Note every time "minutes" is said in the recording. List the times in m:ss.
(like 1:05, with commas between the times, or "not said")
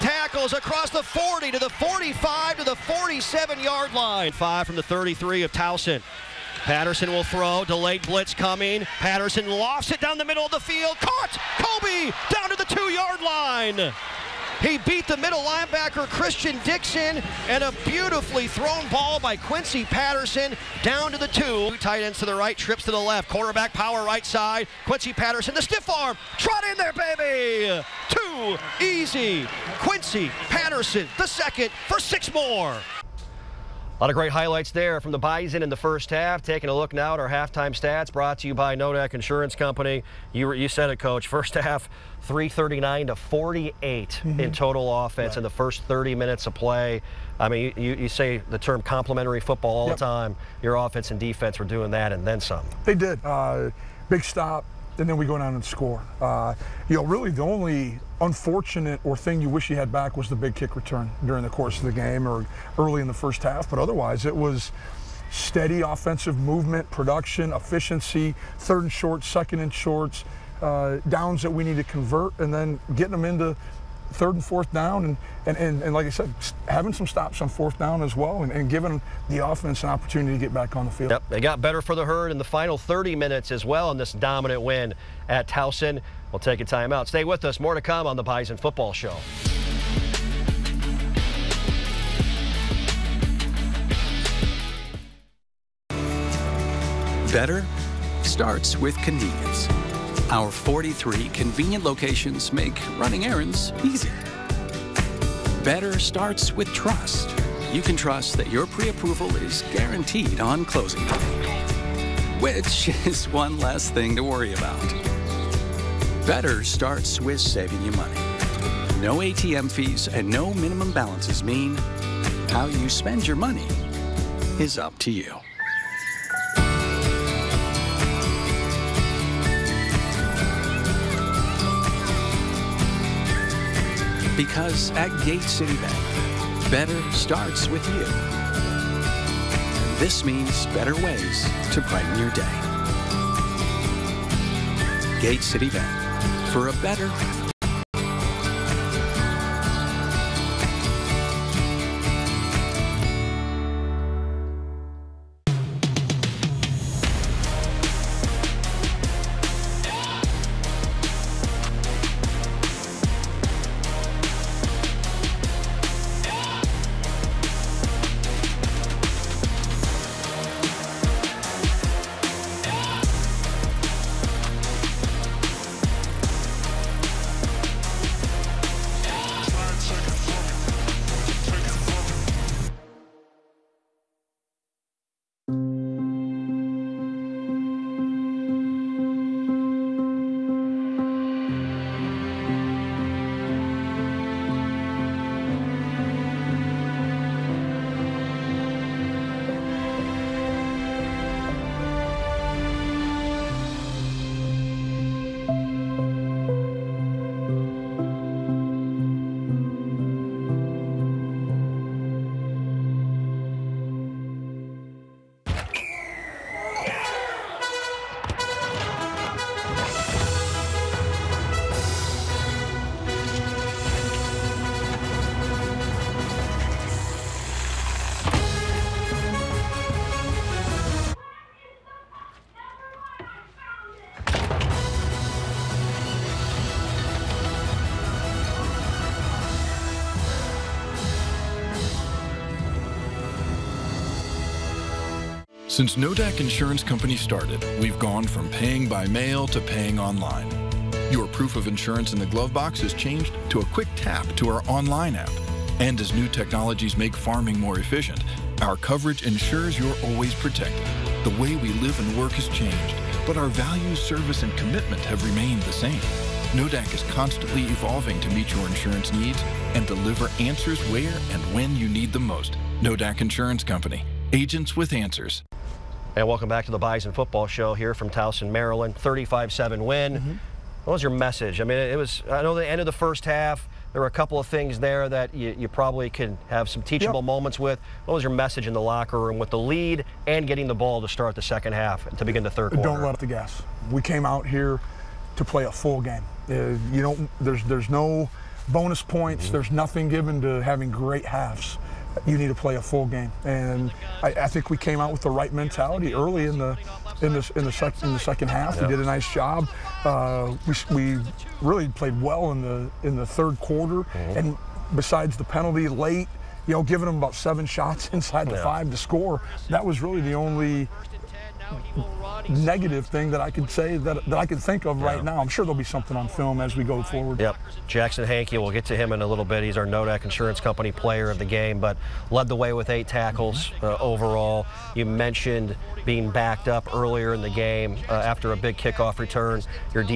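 0:46, 1:23.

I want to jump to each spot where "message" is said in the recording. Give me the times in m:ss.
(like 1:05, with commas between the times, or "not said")
4:41, 4:48.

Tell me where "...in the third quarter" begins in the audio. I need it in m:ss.
5:13.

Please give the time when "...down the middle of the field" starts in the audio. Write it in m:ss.
0:09.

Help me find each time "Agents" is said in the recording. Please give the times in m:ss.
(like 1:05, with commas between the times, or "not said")
4:34.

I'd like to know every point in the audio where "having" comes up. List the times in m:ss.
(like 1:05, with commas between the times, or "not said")
1:16, 5:00.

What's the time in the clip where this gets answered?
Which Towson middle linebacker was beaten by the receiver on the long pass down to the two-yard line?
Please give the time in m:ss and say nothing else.
0:16.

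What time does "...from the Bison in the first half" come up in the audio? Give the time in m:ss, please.
0:34.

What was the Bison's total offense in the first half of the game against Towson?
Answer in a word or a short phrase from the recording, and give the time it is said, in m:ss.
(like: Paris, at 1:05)
339, at 0:42.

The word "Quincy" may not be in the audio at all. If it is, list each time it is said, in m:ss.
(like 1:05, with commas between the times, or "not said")
0:19, 0:24, 0:29.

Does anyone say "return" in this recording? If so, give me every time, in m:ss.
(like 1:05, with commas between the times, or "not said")
1:00, 5:39.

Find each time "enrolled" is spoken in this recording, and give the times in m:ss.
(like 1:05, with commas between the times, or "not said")
not said.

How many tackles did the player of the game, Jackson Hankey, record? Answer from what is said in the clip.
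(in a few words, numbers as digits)
8.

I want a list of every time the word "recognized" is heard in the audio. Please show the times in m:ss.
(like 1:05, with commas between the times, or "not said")
not said.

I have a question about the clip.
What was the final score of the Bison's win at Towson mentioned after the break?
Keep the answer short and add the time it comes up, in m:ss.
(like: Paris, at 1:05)
35-7, at 4:38.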